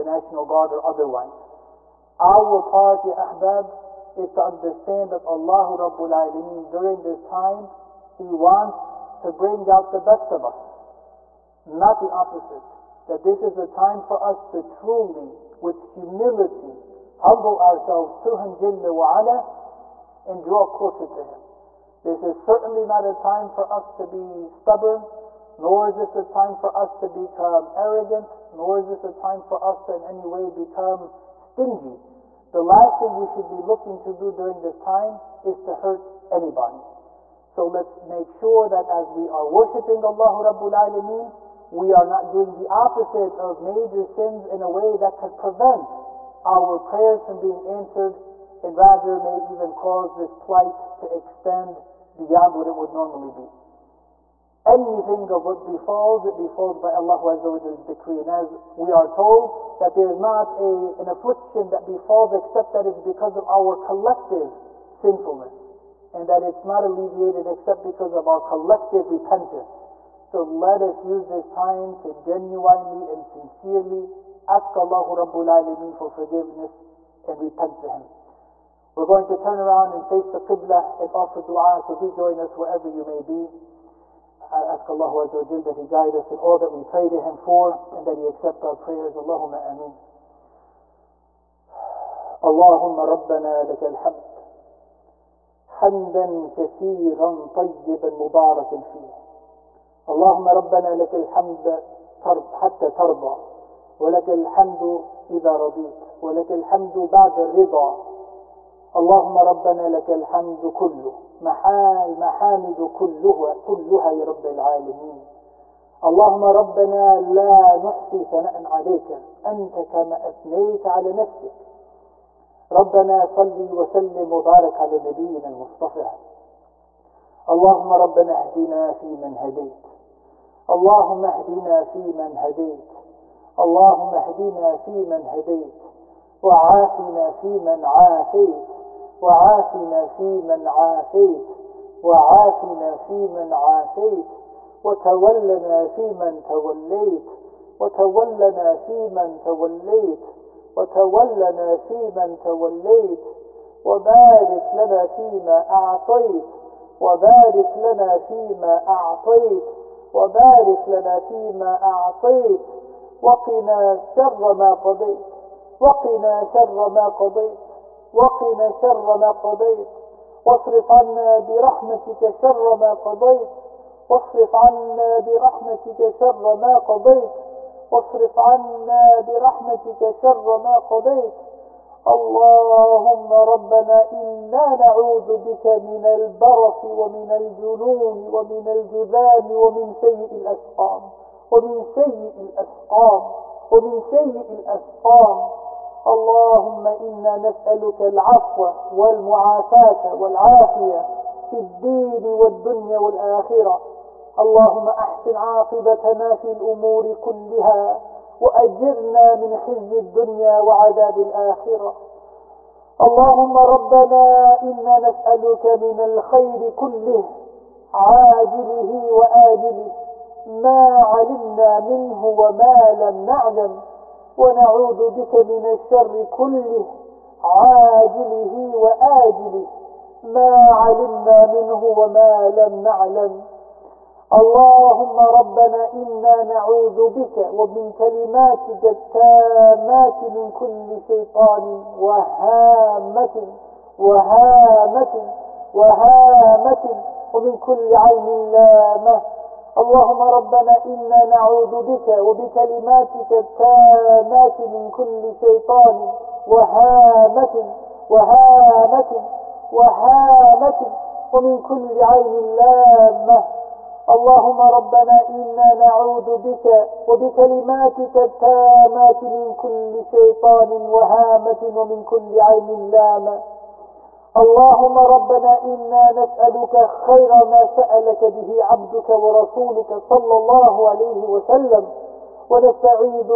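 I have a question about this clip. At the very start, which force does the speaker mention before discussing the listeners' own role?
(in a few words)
National Guard.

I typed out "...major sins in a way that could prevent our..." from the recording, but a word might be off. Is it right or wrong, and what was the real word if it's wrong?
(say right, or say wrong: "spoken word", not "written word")
right.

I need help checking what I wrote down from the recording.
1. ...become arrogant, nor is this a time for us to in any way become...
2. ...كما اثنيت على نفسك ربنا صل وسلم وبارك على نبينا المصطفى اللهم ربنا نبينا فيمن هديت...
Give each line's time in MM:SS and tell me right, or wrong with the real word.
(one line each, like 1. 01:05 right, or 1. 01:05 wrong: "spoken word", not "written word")
1. 00:27 right
2. 01:59 wrong: "اهدنا", not "نبينا".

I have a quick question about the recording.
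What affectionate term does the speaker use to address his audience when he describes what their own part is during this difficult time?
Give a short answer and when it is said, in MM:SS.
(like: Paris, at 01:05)
Ahbab, at 00:03.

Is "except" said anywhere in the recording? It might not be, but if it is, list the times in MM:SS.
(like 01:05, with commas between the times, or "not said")
01:02, 01:07.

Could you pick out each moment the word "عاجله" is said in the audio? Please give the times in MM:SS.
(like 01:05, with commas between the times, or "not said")
03:37, 03:47.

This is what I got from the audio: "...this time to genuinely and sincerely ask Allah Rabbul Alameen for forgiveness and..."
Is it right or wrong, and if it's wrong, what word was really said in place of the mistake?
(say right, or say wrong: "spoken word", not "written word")
right.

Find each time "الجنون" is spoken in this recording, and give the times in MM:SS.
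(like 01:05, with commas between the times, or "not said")
03:07.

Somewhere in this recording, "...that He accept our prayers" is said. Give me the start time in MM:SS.
01:28.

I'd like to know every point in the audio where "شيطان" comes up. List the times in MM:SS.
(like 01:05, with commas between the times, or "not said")
04:01, 04:15, 04:30.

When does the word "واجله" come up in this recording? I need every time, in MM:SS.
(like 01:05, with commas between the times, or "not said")
03:39, 03:48.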